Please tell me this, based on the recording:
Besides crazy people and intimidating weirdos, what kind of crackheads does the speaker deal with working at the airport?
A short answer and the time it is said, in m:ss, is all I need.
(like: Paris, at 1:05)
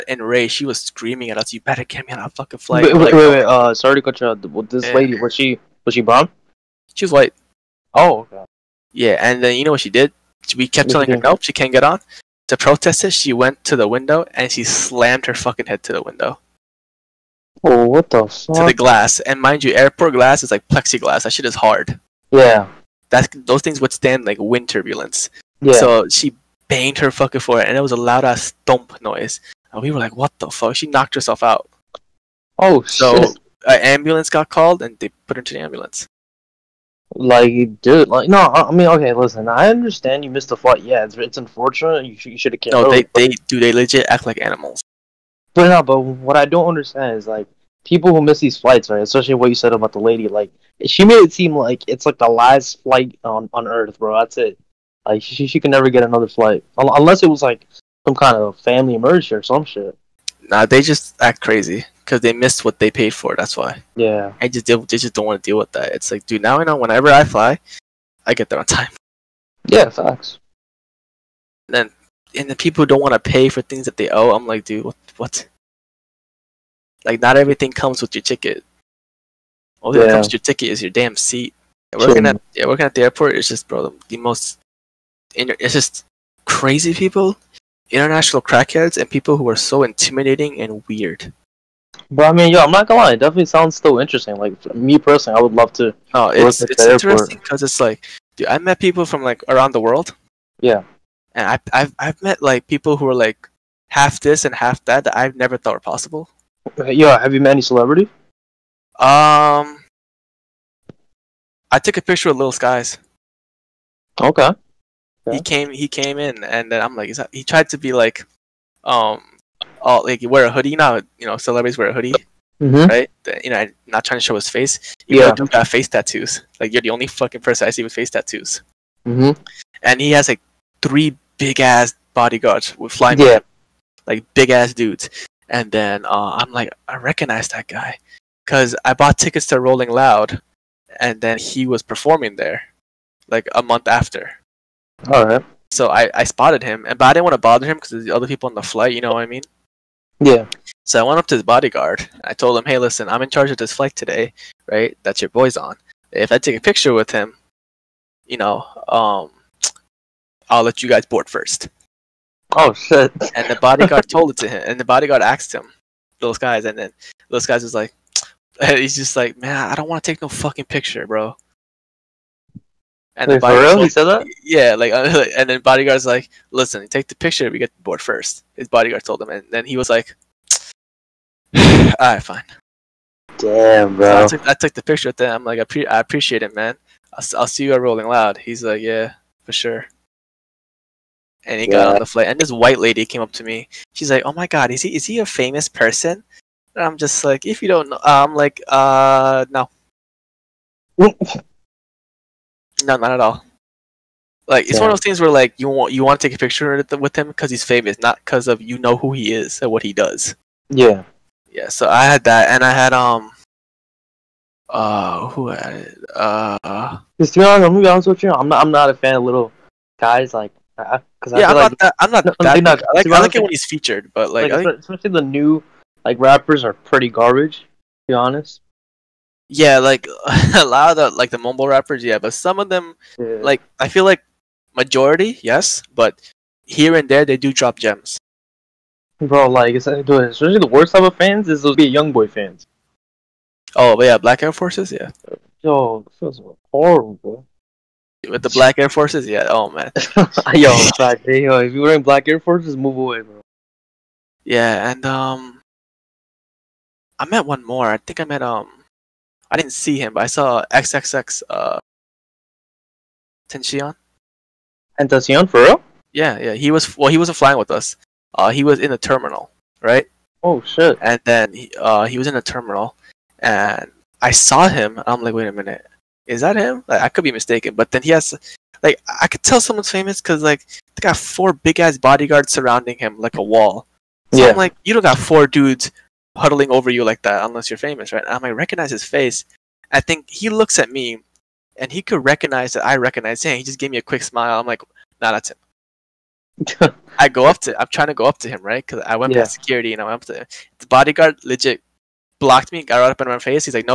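international, at 1:27.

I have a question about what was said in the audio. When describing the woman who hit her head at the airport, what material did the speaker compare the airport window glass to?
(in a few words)
plexiglass.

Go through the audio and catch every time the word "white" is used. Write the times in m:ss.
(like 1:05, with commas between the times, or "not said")
0:07, 3:12.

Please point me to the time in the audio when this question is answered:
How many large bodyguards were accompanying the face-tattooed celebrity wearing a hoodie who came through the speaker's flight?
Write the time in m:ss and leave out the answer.
2:10.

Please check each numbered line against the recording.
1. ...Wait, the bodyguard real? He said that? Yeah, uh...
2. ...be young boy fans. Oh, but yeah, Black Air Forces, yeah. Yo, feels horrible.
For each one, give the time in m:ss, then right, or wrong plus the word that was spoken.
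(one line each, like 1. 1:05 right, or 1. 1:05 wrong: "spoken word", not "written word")
1. 2:53 right
2. 4:01 right.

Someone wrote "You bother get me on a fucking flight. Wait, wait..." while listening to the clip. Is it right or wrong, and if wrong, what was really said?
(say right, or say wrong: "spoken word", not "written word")
wrong: "better", not "bother".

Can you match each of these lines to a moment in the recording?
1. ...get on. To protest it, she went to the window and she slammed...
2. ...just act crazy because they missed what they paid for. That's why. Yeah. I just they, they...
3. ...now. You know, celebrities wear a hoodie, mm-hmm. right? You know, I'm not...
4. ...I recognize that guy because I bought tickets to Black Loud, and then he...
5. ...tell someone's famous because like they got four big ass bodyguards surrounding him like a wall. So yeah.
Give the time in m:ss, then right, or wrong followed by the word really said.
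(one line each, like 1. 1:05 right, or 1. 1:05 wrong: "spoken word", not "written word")
1. 0:11 right
2. 1:00 right
3. 2:00 right
4. 2:16 wrong: "Rolling", not "Black"
5. 4:39 right.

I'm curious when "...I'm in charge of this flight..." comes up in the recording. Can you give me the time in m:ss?
2:33.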